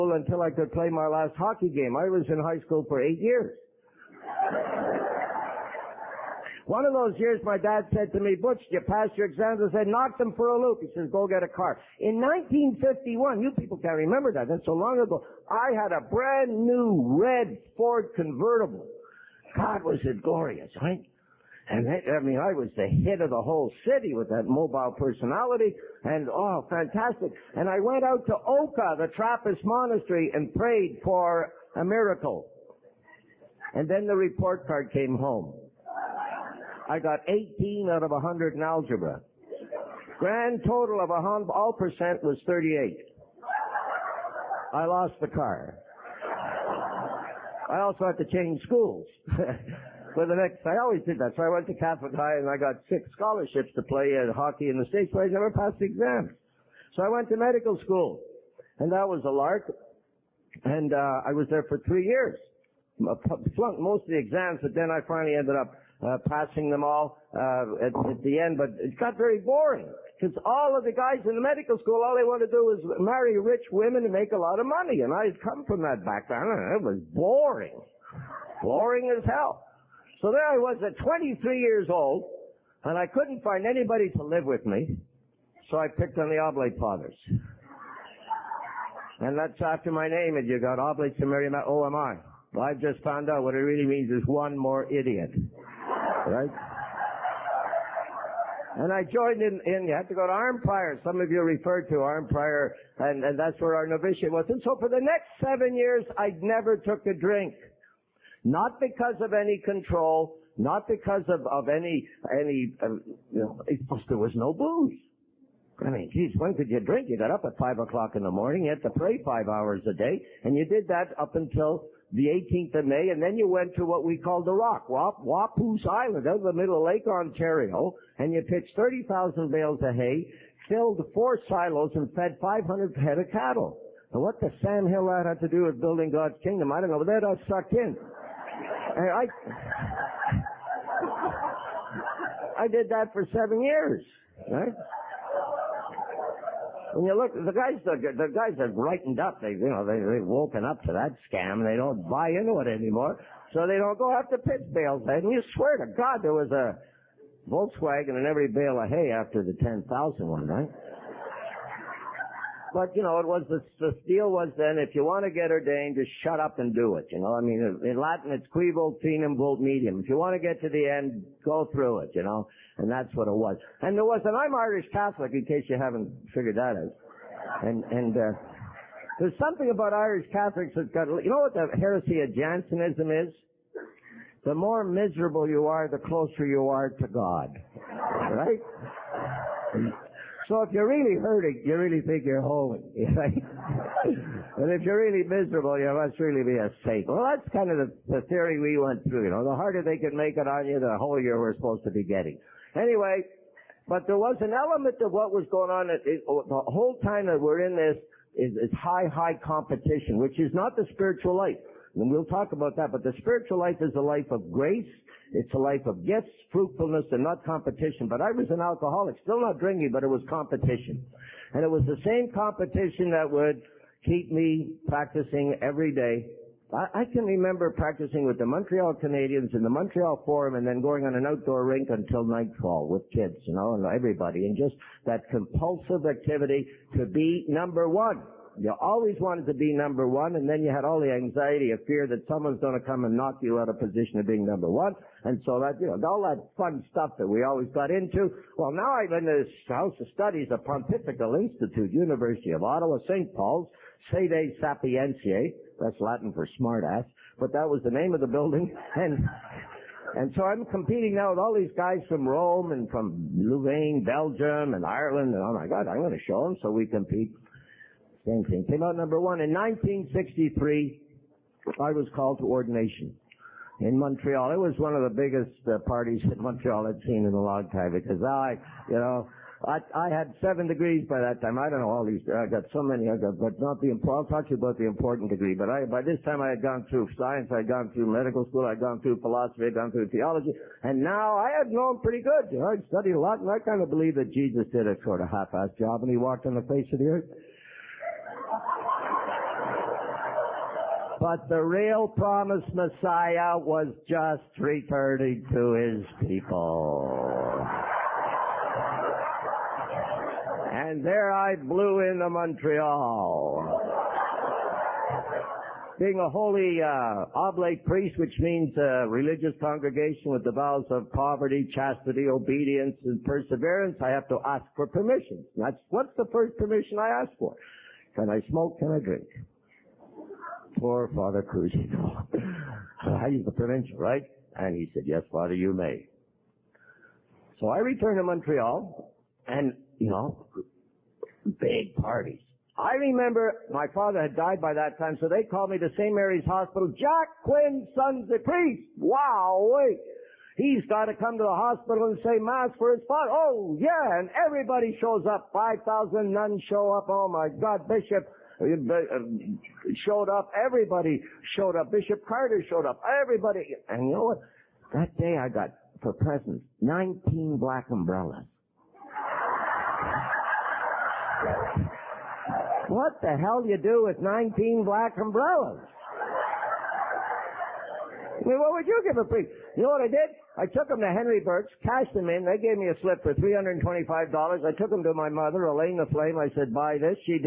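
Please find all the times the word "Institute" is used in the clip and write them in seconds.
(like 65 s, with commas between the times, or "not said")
251 s.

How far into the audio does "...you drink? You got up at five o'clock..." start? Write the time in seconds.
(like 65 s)
116 s.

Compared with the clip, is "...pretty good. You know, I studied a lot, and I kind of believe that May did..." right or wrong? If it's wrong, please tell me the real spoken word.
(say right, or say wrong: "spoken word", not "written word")
wrong: "Jesus", not "May".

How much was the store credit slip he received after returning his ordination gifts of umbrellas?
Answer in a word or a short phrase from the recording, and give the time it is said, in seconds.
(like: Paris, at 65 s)
$325, at 383 s.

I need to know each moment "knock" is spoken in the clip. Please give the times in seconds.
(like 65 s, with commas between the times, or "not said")
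9 s, 243 s.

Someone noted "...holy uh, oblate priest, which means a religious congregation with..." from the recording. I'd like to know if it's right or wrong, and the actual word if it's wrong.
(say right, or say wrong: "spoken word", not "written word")
right.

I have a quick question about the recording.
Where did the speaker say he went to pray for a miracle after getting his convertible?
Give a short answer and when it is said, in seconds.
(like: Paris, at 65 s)
Oka, at 28 s.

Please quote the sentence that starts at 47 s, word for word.
I also had to change schools.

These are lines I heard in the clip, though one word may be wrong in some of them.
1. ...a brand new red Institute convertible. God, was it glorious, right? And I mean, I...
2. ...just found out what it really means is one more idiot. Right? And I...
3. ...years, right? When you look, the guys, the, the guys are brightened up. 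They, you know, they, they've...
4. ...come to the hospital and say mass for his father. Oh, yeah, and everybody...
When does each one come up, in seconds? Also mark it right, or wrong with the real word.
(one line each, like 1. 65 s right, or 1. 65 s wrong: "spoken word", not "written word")
1. 15 s wrong: "Ford", not "Institute"
2. 92 s right
3. 143 s right
4. 351 s right.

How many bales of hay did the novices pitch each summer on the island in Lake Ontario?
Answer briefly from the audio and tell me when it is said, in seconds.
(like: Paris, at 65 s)
30,000, at 128 s.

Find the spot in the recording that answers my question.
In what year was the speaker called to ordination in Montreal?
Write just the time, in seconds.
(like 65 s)
269 s.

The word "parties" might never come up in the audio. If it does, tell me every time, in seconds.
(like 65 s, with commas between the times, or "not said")
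275 s, 341 s.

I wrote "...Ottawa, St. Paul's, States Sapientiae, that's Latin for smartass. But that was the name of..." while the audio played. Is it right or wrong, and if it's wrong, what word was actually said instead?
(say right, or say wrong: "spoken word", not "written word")
wrong: "Sede", not "States".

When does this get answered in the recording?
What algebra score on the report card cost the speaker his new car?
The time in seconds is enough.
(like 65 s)
37 s.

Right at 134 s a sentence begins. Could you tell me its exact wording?
And what the sand Hill ad had to do with building God's kingdom, I don't know, but that I sucked in.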